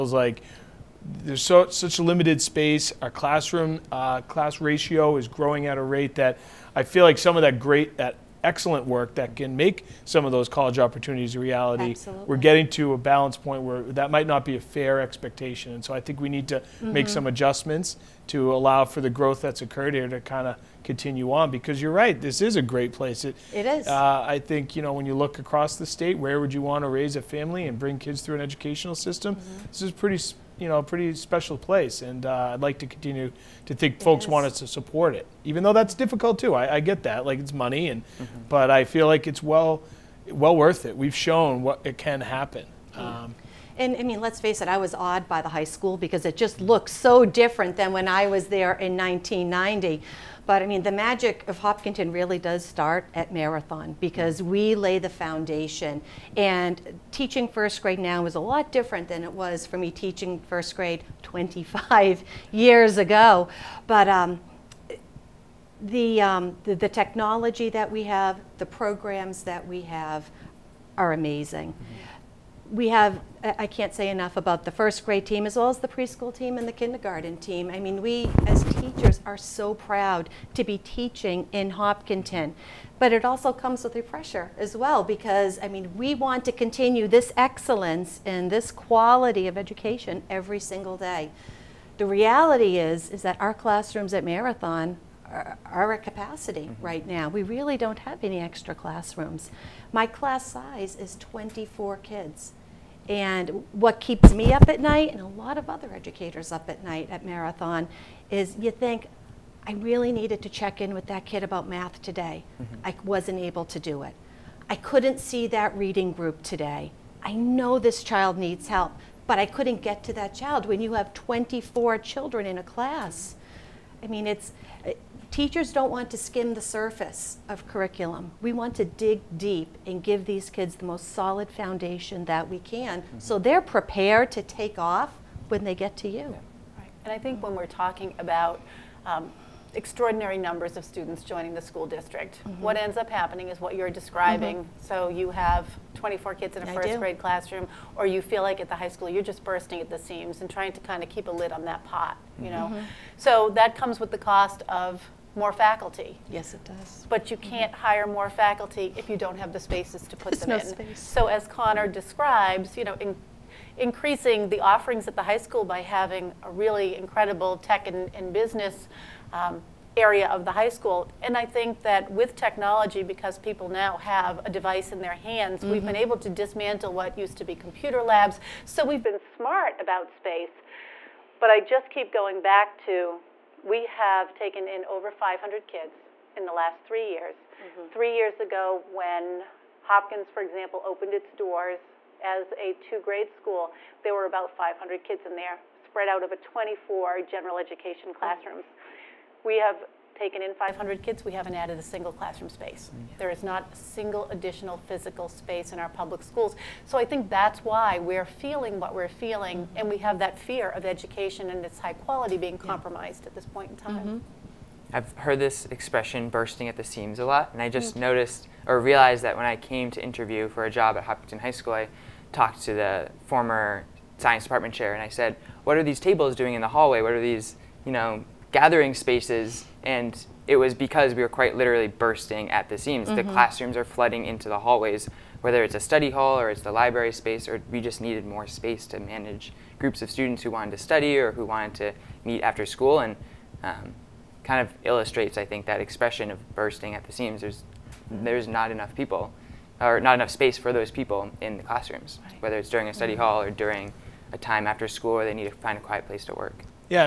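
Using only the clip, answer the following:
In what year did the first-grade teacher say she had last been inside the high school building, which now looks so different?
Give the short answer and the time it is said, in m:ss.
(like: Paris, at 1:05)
1990, at 0:48.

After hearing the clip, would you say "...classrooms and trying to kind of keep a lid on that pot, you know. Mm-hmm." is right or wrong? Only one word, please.
wrong.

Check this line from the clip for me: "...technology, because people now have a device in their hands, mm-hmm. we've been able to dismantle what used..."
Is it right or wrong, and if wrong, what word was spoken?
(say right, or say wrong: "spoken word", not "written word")
right.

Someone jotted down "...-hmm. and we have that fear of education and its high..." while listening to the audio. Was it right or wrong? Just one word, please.
right.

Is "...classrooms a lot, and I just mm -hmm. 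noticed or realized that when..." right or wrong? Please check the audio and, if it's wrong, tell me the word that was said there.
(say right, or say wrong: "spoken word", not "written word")
wrong: "seams", not "classrooms".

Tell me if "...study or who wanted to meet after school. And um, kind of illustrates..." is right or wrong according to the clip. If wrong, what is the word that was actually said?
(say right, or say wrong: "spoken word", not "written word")
right.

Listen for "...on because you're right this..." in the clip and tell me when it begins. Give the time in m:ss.
0:21.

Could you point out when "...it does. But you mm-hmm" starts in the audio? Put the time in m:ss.
2:36.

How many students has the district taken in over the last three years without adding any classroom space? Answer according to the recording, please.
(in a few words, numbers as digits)
over 500.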